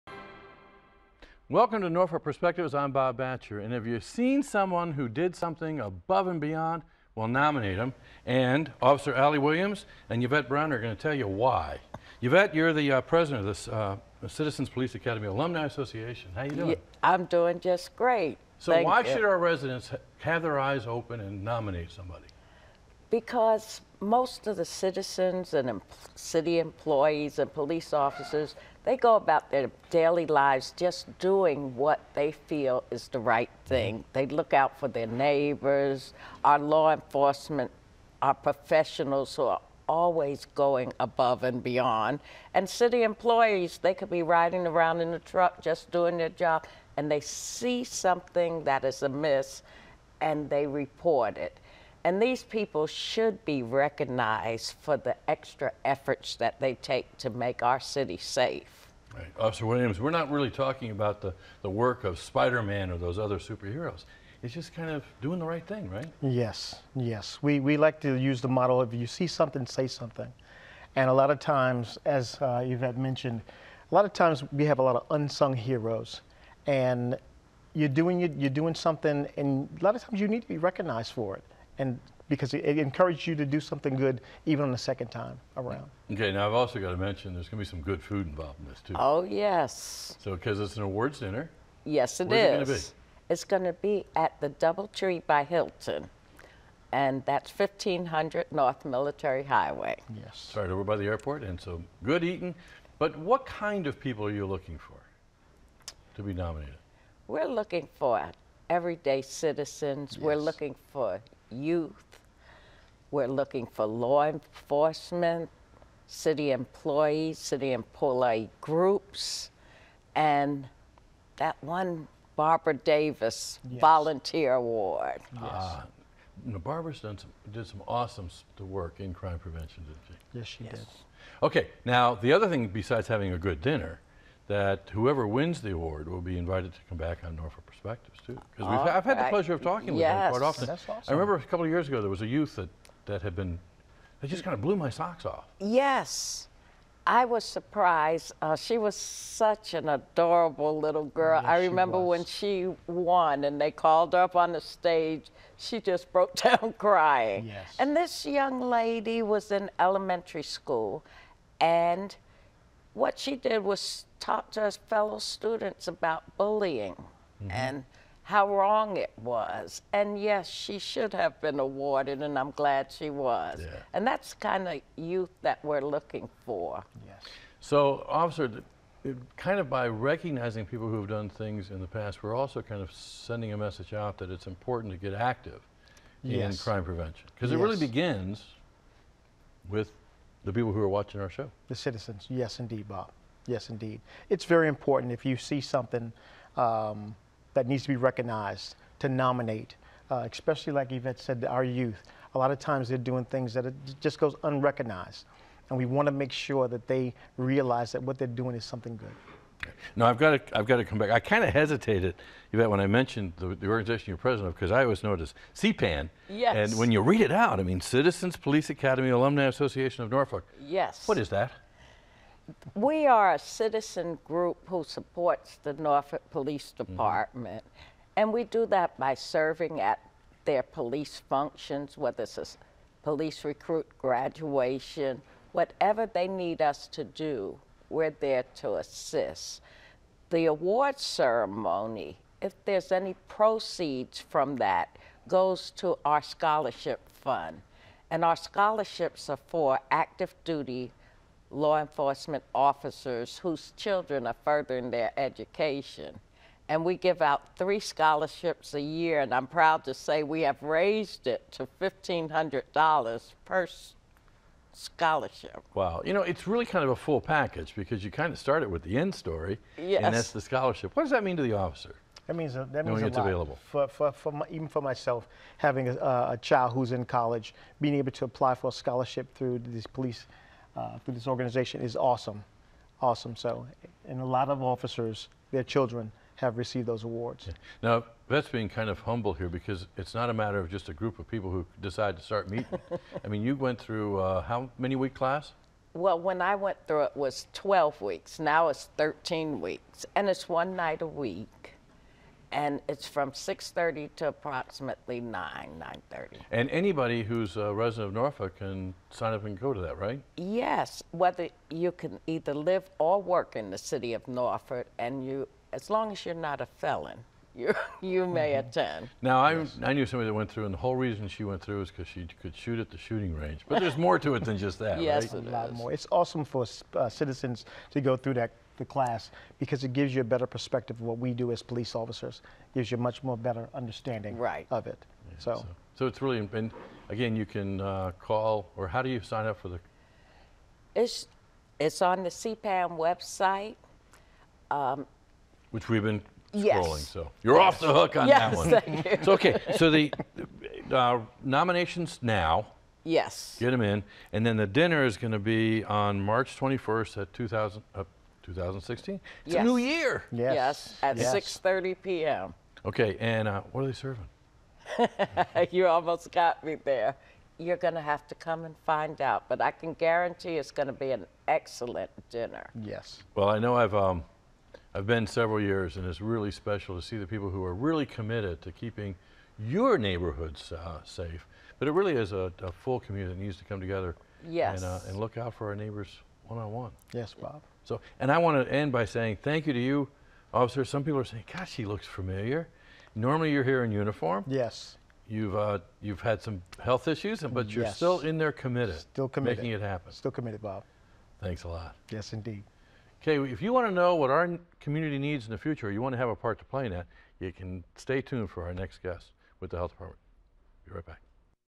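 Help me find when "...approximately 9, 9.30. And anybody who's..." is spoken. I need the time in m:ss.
5:04.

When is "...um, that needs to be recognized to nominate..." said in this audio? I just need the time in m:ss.
3:16.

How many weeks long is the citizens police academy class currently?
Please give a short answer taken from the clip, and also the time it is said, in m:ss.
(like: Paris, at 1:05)
13 weeks, at 4:58.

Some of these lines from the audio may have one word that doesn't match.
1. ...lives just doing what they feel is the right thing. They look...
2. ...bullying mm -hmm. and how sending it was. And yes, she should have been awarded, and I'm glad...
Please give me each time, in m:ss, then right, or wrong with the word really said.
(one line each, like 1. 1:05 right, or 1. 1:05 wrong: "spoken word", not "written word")
1. 0:30 right
2. 2:46 wrong: "wrong", not "sending".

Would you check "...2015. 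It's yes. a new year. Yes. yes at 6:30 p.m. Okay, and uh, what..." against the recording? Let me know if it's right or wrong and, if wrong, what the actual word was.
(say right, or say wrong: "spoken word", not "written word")
wrong: "2016", not "2015".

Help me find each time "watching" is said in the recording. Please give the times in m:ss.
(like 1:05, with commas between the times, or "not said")
3:10.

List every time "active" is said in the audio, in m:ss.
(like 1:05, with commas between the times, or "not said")
3:05, 4:09.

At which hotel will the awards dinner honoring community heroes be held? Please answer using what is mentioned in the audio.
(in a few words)
Doubletree by Hilton.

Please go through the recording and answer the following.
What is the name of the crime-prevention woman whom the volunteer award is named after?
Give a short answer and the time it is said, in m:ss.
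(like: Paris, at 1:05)
Barbara Davis, at 2:02.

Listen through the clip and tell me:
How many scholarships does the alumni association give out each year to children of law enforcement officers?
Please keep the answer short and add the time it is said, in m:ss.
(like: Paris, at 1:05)
3, at 4:17.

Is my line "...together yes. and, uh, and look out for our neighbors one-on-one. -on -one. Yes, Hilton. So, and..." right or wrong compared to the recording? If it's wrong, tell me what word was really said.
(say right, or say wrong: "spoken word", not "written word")
wrong: "Bob", not "Hilton".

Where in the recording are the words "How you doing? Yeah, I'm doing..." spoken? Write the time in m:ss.
0:16.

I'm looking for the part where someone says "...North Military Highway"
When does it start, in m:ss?
1:38.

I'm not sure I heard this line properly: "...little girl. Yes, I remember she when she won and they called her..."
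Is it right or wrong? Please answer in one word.
right.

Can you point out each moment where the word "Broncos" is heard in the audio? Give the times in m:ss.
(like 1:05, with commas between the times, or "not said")
not said.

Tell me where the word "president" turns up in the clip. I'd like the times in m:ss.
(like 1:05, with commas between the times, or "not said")
0:13, 3:34.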